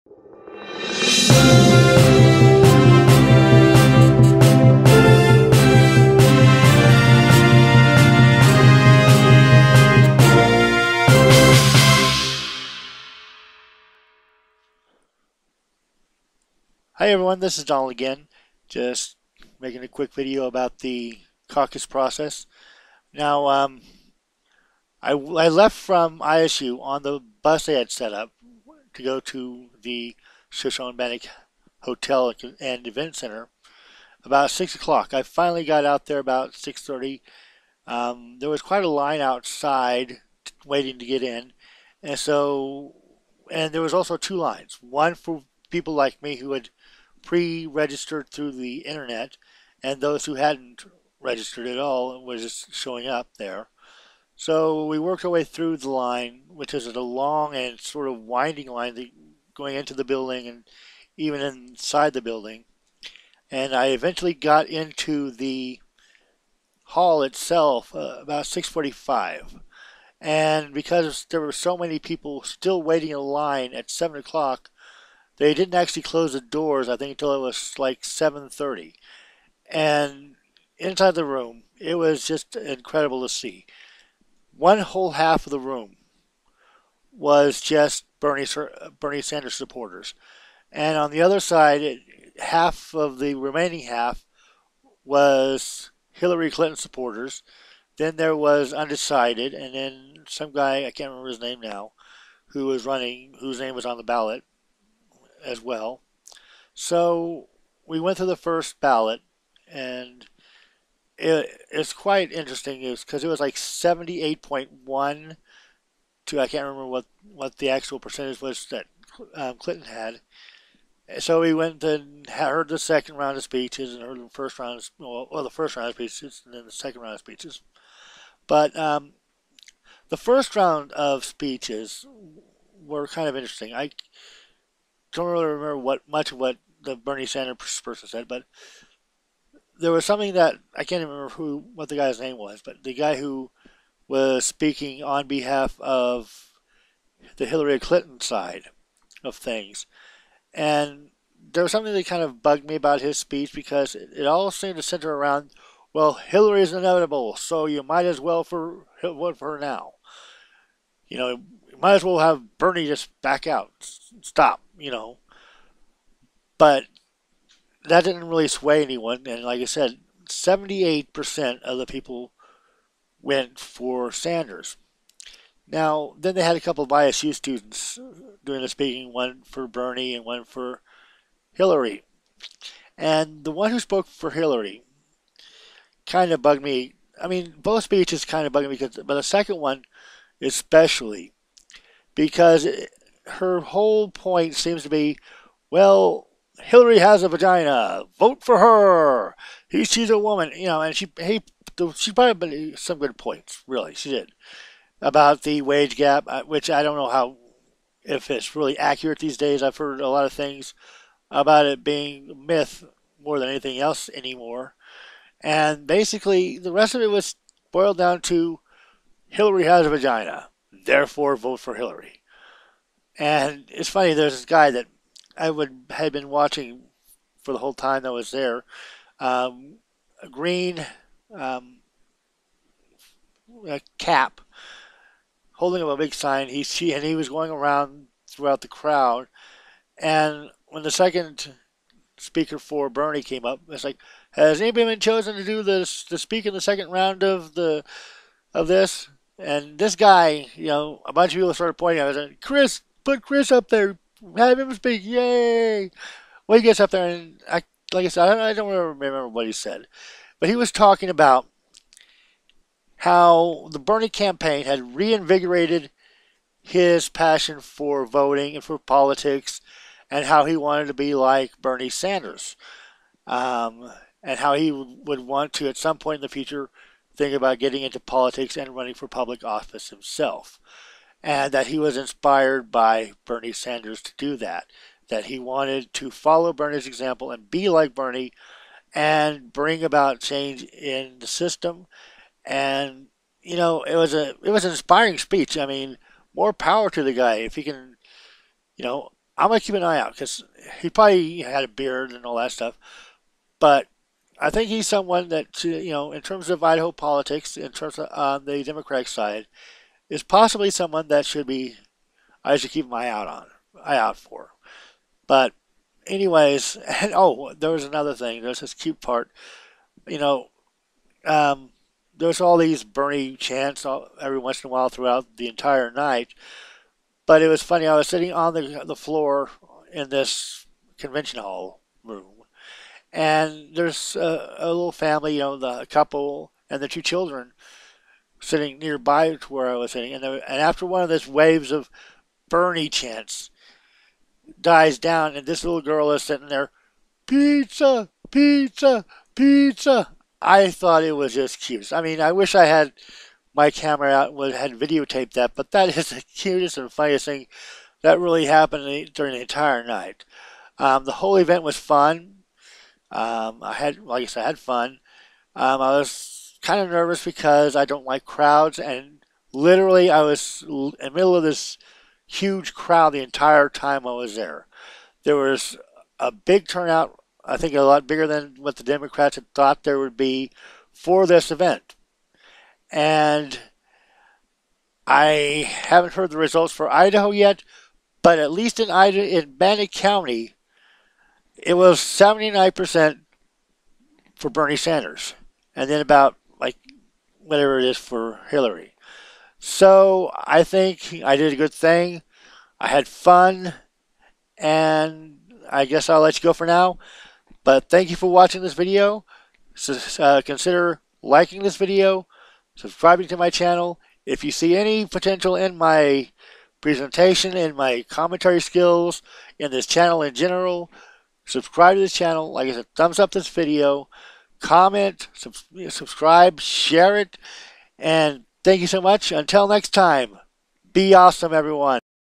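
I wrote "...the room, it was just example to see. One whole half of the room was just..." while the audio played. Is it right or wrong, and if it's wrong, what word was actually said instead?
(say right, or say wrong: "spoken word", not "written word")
wrong: "incredible", not "example".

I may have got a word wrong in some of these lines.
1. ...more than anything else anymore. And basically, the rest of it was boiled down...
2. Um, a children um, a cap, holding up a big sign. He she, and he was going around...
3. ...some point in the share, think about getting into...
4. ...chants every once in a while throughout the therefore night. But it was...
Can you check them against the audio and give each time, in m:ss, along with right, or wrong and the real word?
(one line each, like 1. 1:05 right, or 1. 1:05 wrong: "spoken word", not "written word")
1. 3:33 right
2. 3:49 wrong: "green", not "children"
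3. 4:35 wrong: "future", not "share"
4. 5:23 wrong: "entire", not "therefore".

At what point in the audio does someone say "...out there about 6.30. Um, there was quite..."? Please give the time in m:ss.
0:35.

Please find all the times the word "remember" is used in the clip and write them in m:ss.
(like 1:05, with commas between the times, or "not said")
1:41, 1:56, 2:15, 2:21, 4:18.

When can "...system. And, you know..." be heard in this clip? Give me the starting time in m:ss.
4:51.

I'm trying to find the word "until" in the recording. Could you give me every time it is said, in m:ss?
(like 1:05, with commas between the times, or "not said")
1:17, 7:09.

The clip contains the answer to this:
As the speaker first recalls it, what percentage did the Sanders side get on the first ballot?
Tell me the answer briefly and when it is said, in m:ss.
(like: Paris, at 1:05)
78.1, at 1:53.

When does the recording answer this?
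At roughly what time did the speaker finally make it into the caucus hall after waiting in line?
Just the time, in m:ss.
1:08.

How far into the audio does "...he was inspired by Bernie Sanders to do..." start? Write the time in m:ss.
4:41.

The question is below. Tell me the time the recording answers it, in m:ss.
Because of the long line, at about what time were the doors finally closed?
1:18.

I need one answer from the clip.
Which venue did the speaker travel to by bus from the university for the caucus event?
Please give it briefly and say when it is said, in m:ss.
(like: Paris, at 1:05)
Shoshone Bannock Hotel and Event Center, at 0:30.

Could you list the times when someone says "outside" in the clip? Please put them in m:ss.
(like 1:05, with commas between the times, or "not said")
0:39.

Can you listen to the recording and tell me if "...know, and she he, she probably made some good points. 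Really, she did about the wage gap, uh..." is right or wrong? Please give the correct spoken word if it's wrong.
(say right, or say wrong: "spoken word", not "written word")
right.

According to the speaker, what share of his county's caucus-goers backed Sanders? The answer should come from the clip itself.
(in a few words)
79%.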